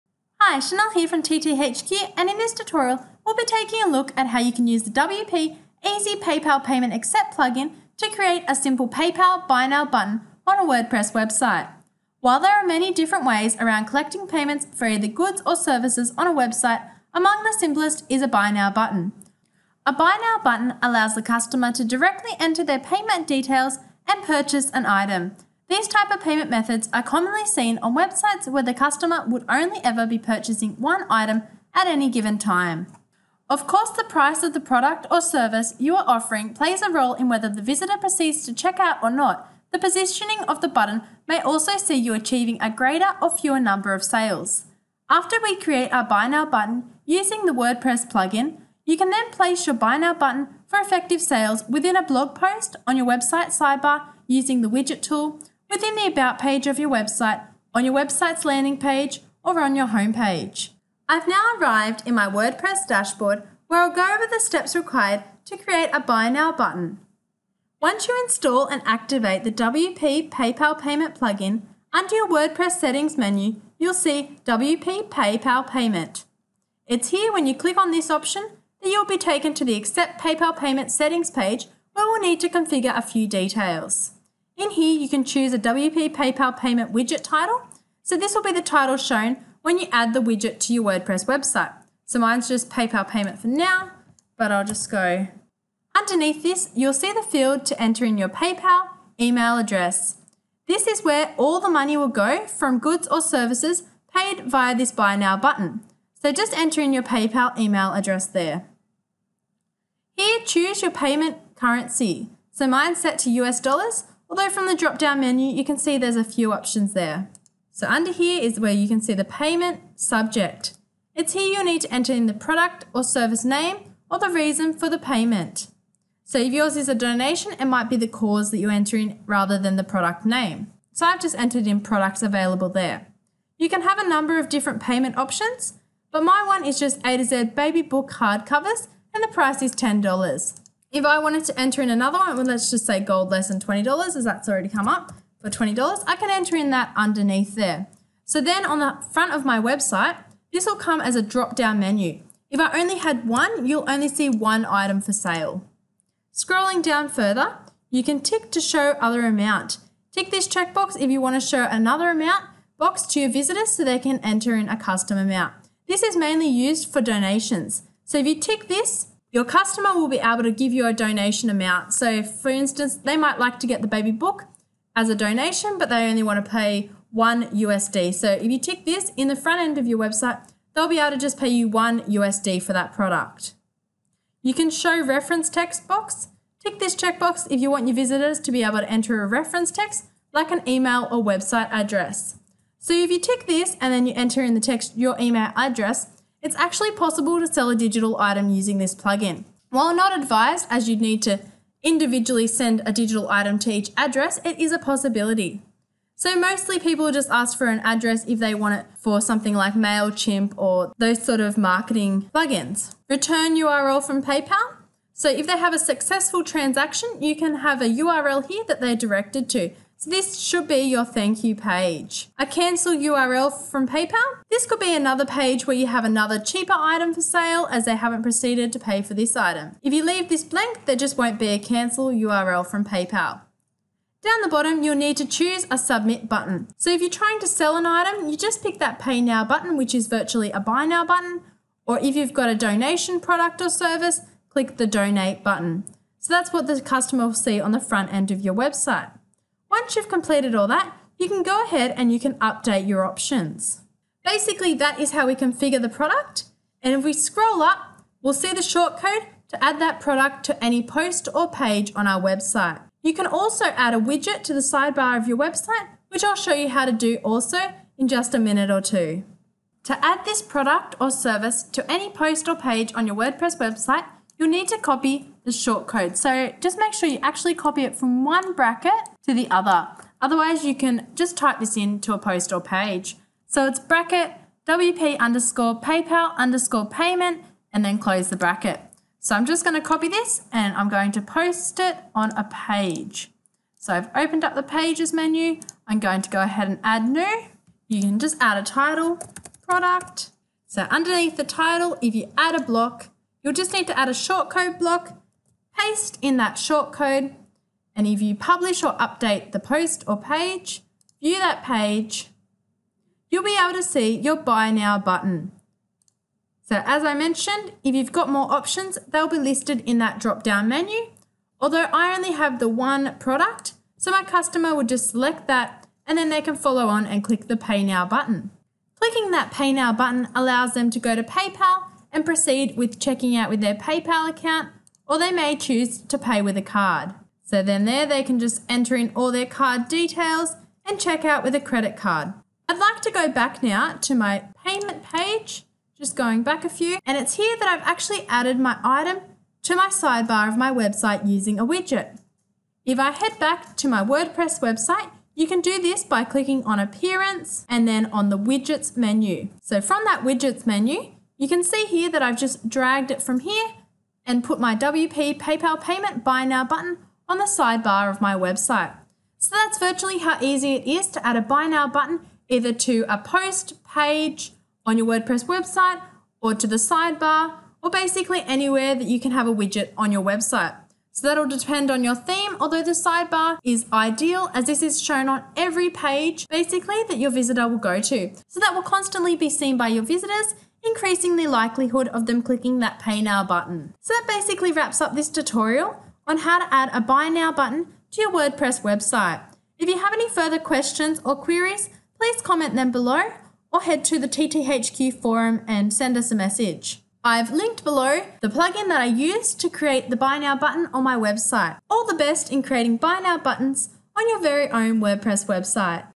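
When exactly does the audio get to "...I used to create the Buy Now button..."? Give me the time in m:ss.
6:49.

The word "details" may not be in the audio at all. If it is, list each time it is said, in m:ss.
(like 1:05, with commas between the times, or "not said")
0:23, 1:23, 5:39.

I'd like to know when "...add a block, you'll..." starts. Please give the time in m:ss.
5:02.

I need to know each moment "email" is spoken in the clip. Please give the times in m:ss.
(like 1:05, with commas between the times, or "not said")
1:39, 1:47, 3:10, 3:15.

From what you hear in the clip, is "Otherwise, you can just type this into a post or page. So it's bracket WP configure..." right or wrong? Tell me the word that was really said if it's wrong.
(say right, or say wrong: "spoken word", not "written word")
wrong: "underscore", not "configure".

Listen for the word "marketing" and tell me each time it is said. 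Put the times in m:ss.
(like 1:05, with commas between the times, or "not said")
3:31.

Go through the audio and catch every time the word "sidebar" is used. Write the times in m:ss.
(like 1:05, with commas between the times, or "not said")
0:53, 4:24, 5:49, 6:07, 6:16, 6:22.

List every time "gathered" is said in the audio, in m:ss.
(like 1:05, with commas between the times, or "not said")
not said.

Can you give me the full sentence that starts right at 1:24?
In here, you can choose a WP PayPal payment widget title.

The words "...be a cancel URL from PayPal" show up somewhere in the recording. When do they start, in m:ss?
3:51.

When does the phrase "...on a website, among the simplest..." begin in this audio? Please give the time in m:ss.
0:16.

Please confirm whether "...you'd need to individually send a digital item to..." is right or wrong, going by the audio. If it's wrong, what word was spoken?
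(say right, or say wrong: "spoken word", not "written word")
right.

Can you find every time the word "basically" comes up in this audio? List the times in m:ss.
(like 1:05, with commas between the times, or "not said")
4:14, 6:17, 6:26, 6:34.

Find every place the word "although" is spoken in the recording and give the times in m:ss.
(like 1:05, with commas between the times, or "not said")
1:54, 5:21, 6:22.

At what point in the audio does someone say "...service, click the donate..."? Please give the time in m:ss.
4:03.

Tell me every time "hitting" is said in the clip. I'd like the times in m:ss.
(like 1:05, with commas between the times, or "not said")
not said.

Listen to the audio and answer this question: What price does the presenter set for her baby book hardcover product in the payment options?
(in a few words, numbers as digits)
$10.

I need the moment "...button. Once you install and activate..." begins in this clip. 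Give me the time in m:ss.
1:06.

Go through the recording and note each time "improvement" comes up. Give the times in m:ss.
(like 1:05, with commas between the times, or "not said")
not said.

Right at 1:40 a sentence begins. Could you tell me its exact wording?
This is where all the money will go from goods or services paid via this Buy Now button.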